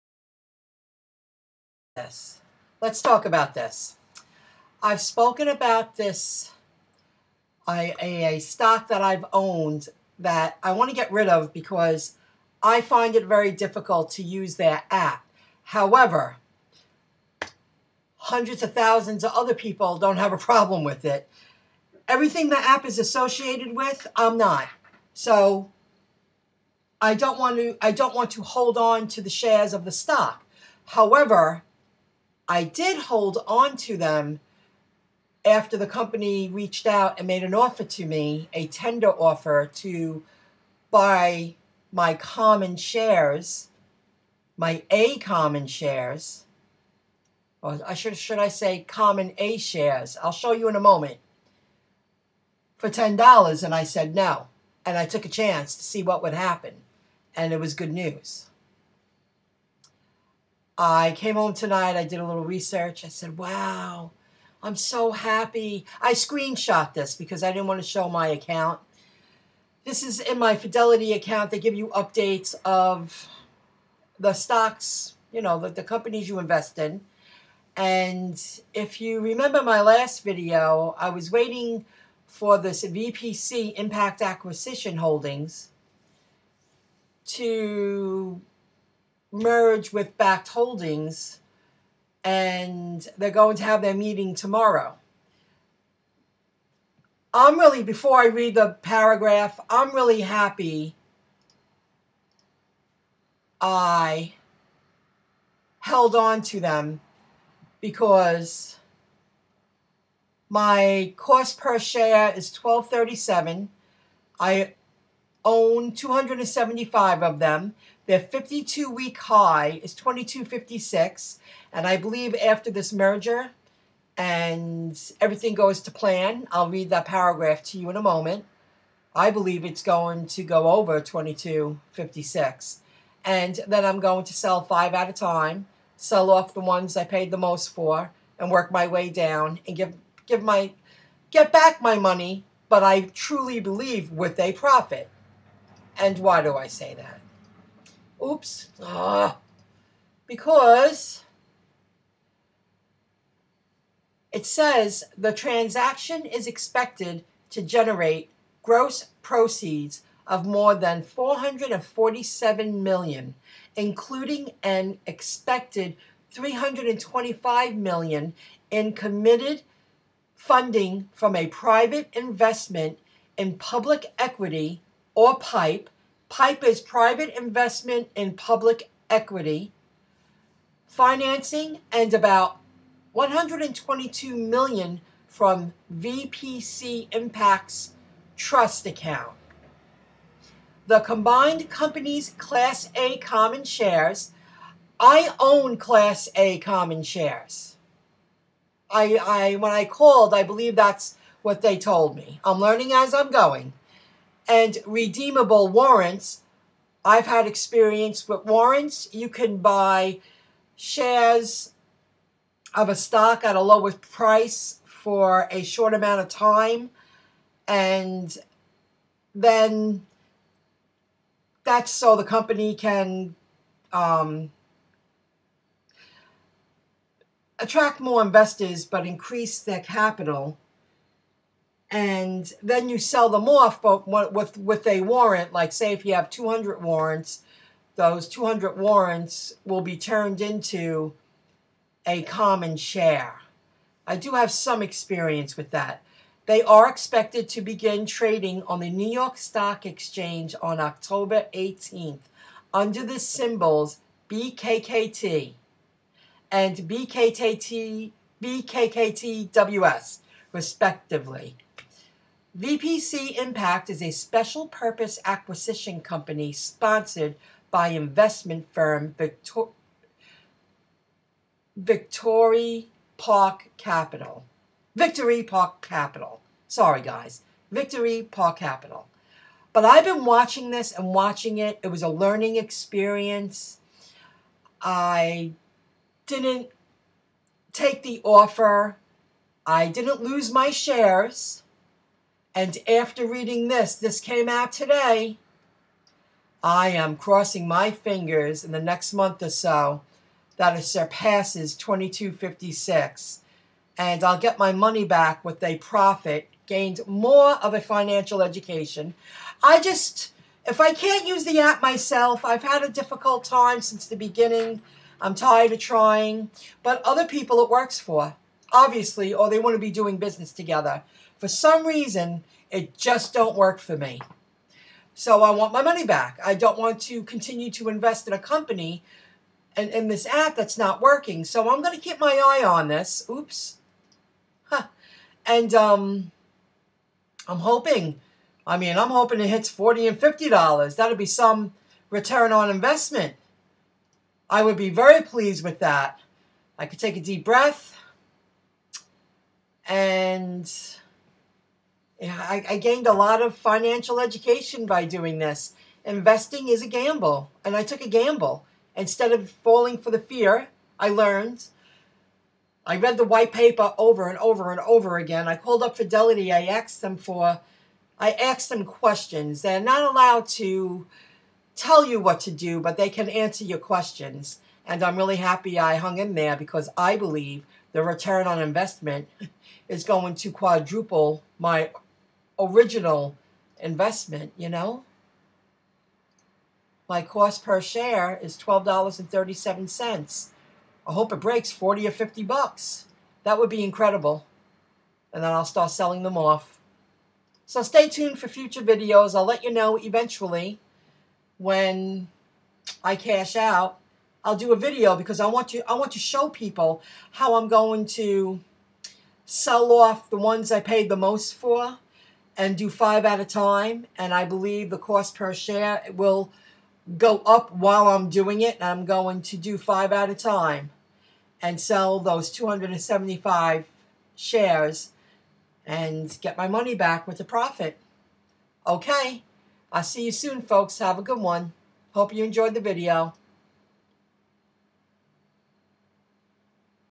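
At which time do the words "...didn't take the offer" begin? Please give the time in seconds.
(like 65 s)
286 s.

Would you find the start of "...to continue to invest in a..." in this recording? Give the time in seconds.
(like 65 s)
327 s.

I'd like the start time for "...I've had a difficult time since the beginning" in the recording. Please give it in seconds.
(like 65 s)
312 s.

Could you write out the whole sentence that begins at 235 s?
Like say, if you have two hundred warrants, those two hundred warrants will be turned into a common share.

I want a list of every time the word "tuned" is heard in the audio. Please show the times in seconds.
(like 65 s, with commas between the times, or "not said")
398 s.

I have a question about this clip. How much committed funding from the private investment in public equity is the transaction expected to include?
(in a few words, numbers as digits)
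$325 million.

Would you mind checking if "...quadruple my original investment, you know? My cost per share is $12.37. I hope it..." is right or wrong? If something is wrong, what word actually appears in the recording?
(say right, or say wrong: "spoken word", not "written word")
right.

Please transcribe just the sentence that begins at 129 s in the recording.
I believe it's going to go over 2256.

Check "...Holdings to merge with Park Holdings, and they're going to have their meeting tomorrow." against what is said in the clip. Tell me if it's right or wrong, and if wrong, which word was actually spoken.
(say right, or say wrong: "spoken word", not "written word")
wrong: "Bakkt", not "Park".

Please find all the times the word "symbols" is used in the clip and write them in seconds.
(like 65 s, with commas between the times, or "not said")
253 s.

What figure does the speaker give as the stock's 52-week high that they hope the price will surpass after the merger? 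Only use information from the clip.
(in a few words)
22.56.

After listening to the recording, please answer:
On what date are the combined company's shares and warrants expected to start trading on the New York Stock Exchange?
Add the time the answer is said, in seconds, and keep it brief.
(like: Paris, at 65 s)
October 18, at 250 s.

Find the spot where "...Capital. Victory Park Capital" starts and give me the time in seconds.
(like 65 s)
273 s.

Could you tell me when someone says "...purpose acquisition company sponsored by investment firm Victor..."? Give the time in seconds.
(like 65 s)
264 s.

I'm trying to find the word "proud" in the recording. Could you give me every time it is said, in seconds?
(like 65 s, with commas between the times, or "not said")
not said.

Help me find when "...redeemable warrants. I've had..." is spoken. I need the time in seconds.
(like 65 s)
204 s.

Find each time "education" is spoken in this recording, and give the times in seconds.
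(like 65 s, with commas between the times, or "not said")
308 s, 354 s.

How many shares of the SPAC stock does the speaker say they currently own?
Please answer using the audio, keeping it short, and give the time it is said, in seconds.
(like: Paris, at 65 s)
275, at 114 s.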